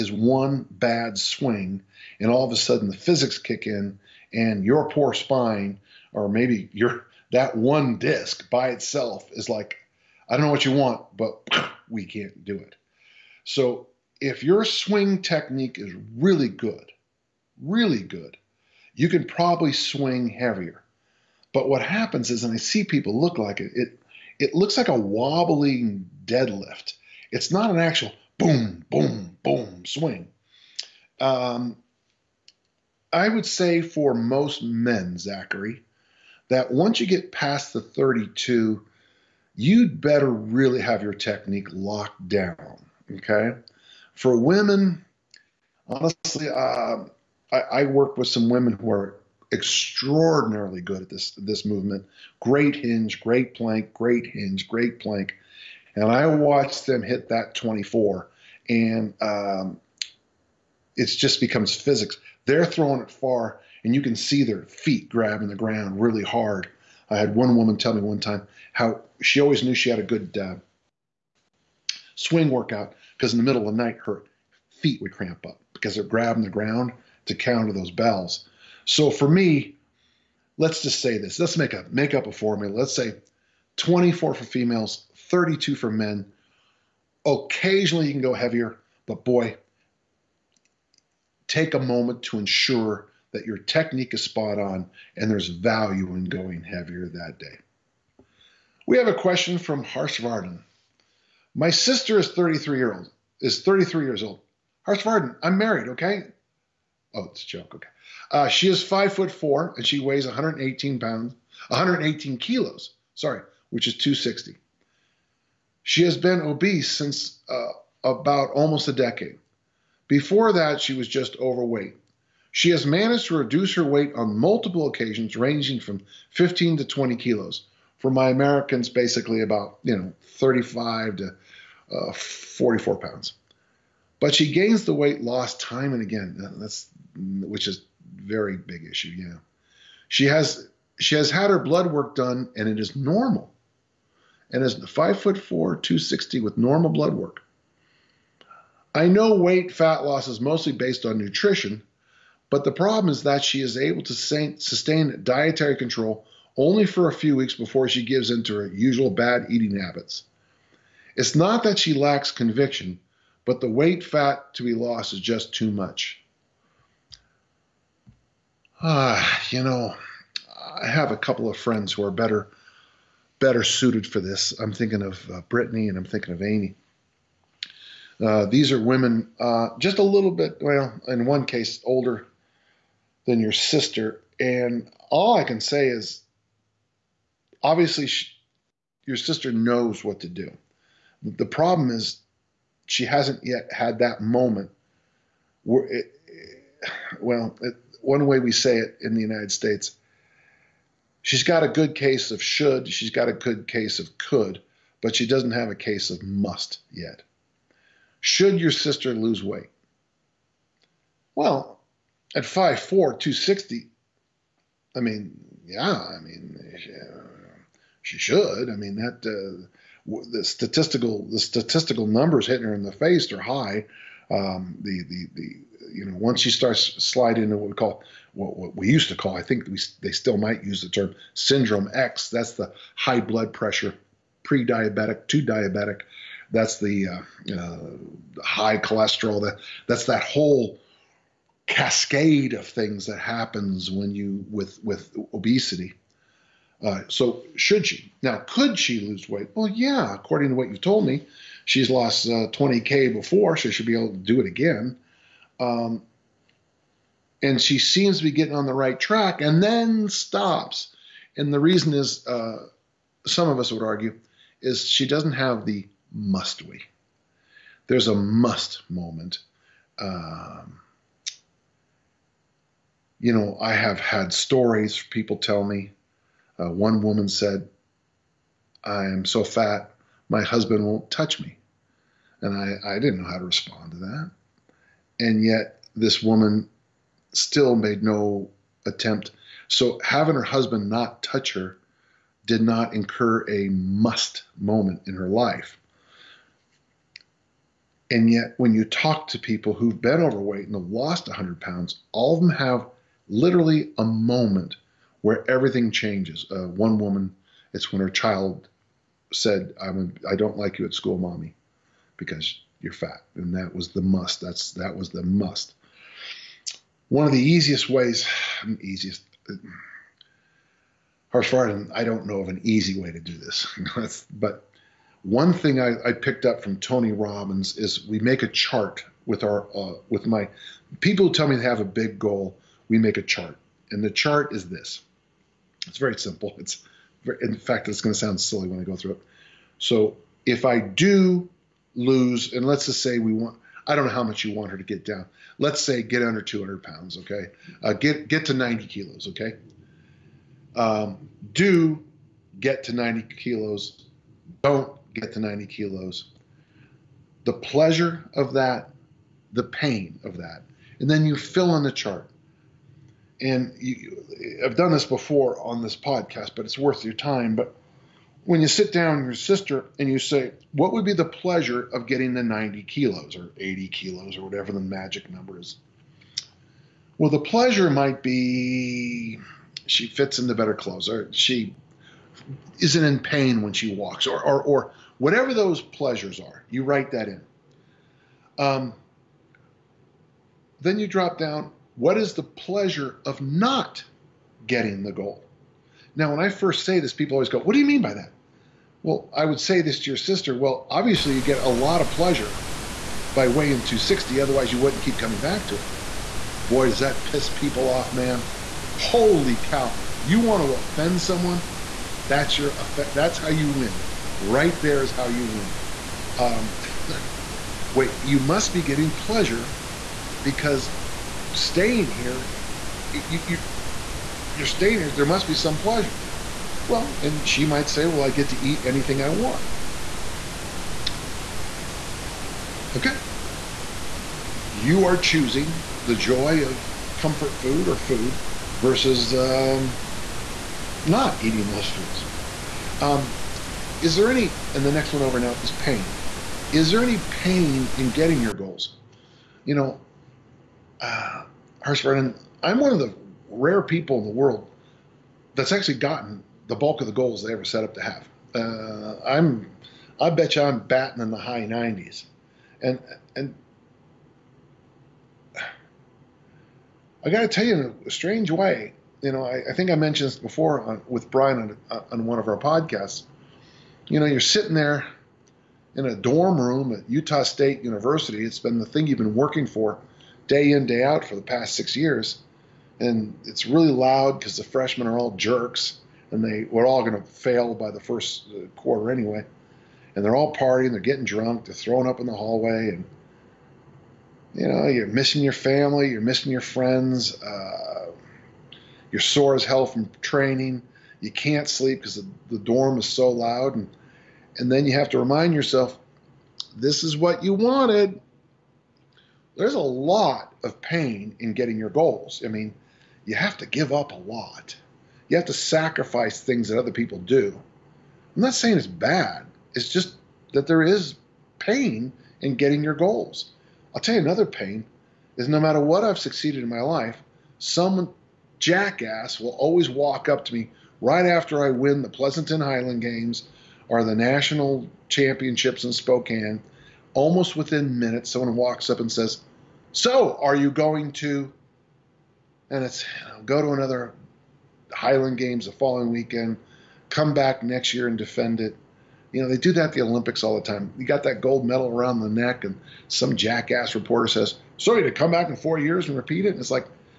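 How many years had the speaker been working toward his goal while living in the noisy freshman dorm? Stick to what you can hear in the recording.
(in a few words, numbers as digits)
6 years.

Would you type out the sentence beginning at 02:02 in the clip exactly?
She has managed to reduce her weight on multiple occasions, ranging from 15 to 20 kilos.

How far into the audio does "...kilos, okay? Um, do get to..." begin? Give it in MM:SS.
05:48.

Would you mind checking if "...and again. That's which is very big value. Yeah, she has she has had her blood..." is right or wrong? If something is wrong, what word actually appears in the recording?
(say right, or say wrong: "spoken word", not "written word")
wrong: "issue", not "value".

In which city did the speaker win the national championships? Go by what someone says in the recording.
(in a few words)
Spokane.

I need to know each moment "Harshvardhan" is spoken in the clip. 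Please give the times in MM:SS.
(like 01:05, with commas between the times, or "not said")
01:39, 01:44, 05:21.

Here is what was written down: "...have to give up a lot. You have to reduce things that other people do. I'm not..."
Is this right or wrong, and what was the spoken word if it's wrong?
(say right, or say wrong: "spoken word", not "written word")
wrong: "sacrifice", not "reduce".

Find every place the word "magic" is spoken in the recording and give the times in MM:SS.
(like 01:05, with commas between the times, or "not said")
06:14.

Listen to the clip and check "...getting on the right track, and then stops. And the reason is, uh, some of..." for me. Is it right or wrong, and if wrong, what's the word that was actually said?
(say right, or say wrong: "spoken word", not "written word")
right.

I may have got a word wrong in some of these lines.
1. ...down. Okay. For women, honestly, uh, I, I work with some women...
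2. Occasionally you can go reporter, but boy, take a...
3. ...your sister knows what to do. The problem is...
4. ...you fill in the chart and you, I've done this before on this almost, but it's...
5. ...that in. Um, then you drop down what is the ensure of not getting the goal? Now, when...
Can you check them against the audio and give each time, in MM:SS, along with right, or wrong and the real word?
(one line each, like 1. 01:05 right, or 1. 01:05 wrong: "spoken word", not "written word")
1. 00:42 right
2. 01:27 wrong: "heavier", not "reporter"
3. 03:09 right
4. 06:01 wrong: "podcast", not "almost"
5. 06:27 wrong: "pleasure", not "ensure".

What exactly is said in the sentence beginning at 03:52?
That's the high blood pressure, pre-diabetic to diabetic.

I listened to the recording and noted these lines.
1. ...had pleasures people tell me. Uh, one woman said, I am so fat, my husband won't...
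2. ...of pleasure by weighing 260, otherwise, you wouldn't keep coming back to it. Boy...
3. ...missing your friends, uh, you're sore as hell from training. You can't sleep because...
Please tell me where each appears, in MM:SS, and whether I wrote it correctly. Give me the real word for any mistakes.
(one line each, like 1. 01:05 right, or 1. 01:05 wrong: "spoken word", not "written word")
1. 04:34 wrong: "stories", not "pleasures"
2. 06:42 right
3. 08:16 right.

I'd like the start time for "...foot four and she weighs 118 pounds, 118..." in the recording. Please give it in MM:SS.
01:49.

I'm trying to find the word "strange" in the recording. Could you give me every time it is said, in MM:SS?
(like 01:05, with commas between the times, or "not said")
07:48.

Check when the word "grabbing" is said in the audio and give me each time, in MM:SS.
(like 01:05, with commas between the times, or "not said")
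01:05, 01:16.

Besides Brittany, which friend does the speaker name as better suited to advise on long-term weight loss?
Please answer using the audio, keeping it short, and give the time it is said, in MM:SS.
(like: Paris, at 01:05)
Amy, at 02:56.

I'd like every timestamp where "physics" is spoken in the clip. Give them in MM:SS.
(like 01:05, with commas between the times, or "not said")
00:02, 01:01.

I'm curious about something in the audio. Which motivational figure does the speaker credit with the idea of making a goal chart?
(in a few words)
Tony Robbins.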